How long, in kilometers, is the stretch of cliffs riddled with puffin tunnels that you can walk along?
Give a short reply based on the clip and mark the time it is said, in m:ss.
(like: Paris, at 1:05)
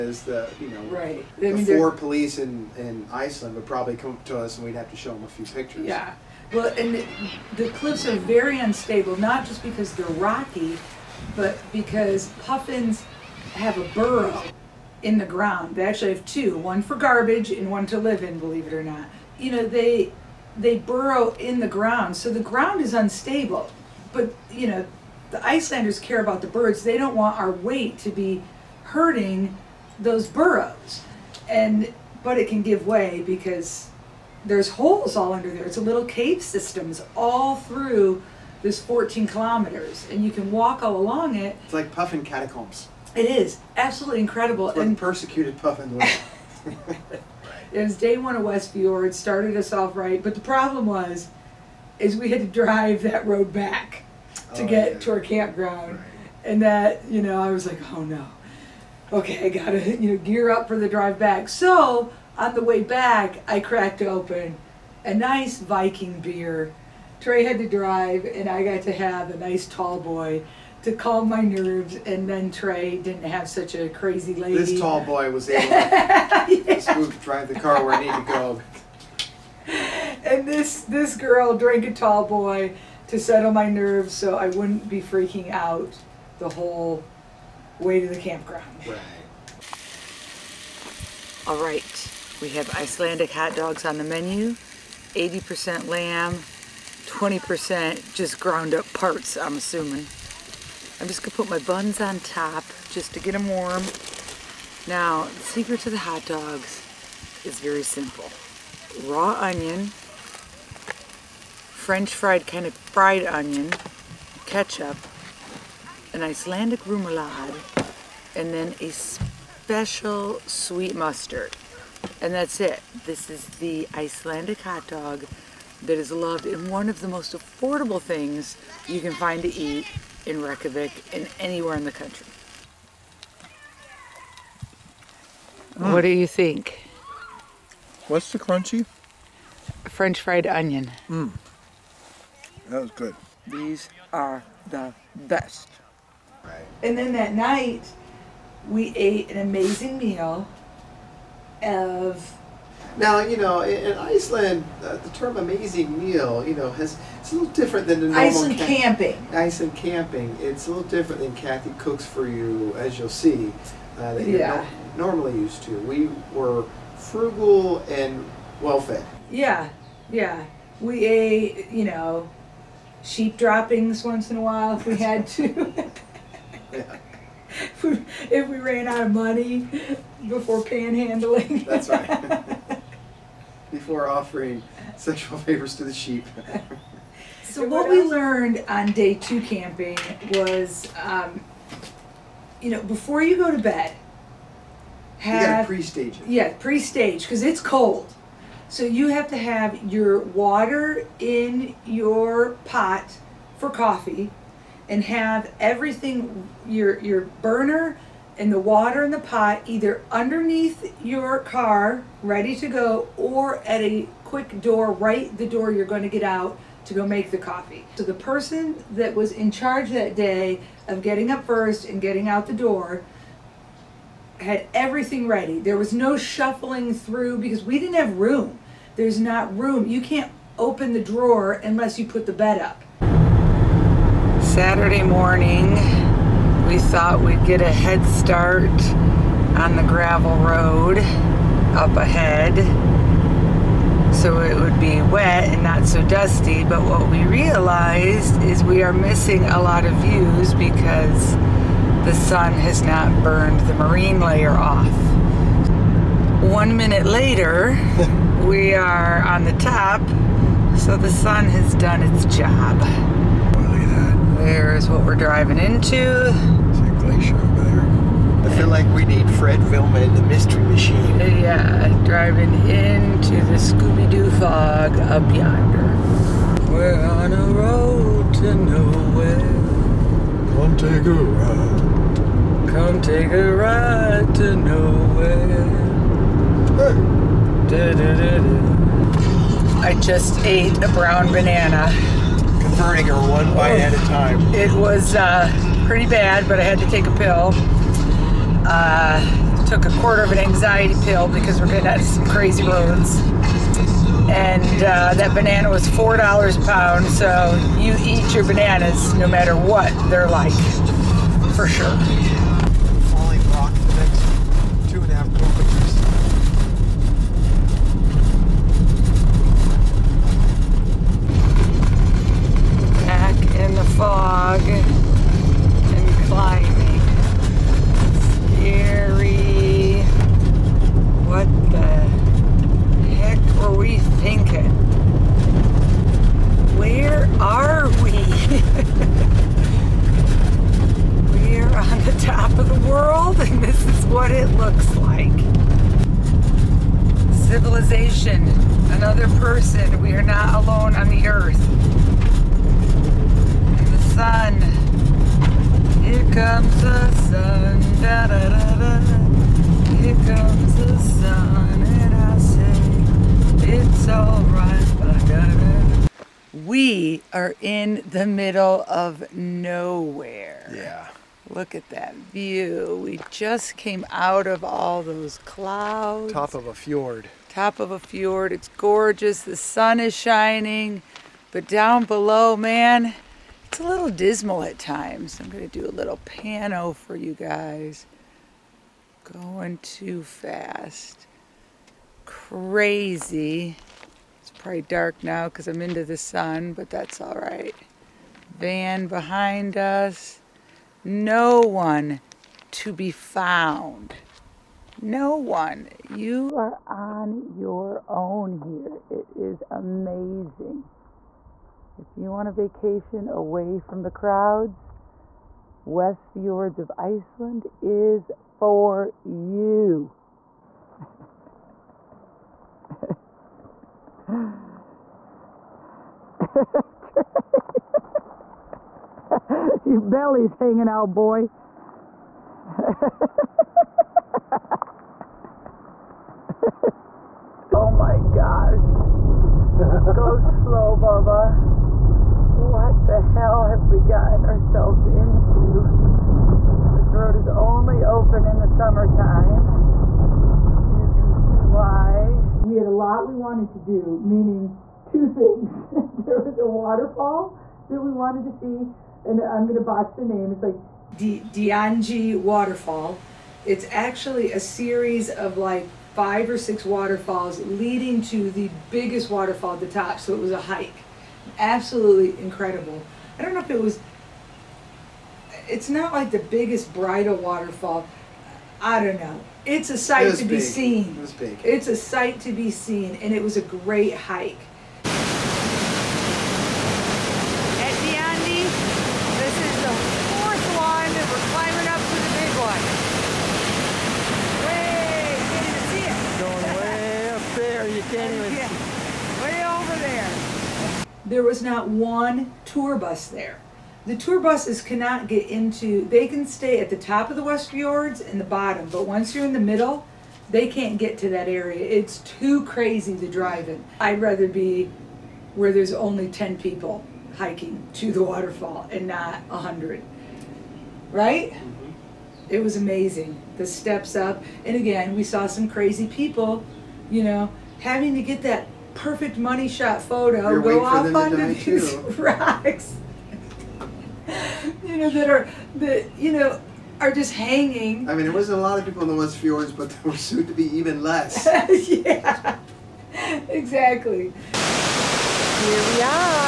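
14 kilometers, at 0:38.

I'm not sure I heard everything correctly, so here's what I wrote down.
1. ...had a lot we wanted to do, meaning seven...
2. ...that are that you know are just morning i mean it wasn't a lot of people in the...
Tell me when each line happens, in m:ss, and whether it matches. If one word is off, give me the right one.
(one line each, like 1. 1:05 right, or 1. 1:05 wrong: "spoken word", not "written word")
1. 7:32 wrong: "two", not "seven"
2. 8:55 wrong: "hanging", not "morning".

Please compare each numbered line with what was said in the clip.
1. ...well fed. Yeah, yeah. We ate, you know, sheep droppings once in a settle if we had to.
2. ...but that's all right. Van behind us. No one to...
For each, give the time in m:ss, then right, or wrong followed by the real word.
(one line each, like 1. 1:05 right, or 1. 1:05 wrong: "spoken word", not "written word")
1. 2:48 wrong: "while", not "settle"
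2. 6:36 right.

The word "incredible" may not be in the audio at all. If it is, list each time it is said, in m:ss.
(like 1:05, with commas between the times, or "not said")
0:44, 7:52.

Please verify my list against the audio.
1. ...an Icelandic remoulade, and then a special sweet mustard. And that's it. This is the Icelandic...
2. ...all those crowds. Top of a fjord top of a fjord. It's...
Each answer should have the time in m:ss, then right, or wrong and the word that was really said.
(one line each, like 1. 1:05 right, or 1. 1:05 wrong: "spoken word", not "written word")
1. 1:56 right
2. 6:14 wrong: "clouds", not "crowds".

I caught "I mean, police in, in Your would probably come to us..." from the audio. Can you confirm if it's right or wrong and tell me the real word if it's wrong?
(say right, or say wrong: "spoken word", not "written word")
wrong: "Iceland", not "Your".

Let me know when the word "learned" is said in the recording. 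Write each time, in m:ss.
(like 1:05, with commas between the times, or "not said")
3:08.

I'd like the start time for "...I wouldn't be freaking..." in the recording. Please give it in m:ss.
1:24.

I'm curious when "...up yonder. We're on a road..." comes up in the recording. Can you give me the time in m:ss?
4:34.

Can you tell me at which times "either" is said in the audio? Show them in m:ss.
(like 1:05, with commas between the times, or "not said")
3:29.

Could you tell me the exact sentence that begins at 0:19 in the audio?
You know, they they burrow in the ground.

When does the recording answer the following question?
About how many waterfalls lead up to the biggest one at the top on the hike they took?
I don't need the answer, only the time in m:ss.
7:46.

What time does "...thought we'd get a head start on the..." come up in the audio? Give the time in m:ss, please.
3:56.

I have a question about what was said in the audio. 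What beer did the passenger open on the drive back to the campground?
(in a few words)
Viking.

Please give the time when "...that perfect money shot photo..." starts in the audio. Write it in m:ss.
8:48.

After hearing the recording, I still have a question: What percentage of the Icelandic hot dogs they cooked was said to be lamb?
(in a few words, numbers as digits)
80%.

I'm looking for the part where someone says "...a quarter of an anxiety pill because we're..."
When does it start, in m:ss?
4:59.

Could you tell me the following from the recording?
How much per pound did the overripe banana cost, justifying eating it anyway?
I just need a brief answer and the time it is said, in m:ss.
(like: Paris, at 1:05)
$4, at 5:05.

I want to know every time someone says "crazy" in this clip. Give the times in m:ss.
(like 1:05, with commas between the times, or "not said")
1:13, 5:02, 6:32, 8:32, 8:45.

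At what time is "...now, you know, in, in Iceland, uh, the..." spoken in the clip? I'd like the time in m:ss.
2:32.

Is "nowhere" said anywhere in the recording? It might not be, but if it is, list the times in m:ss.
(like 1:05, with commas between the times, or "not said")
4:38, 4:44, 6:09.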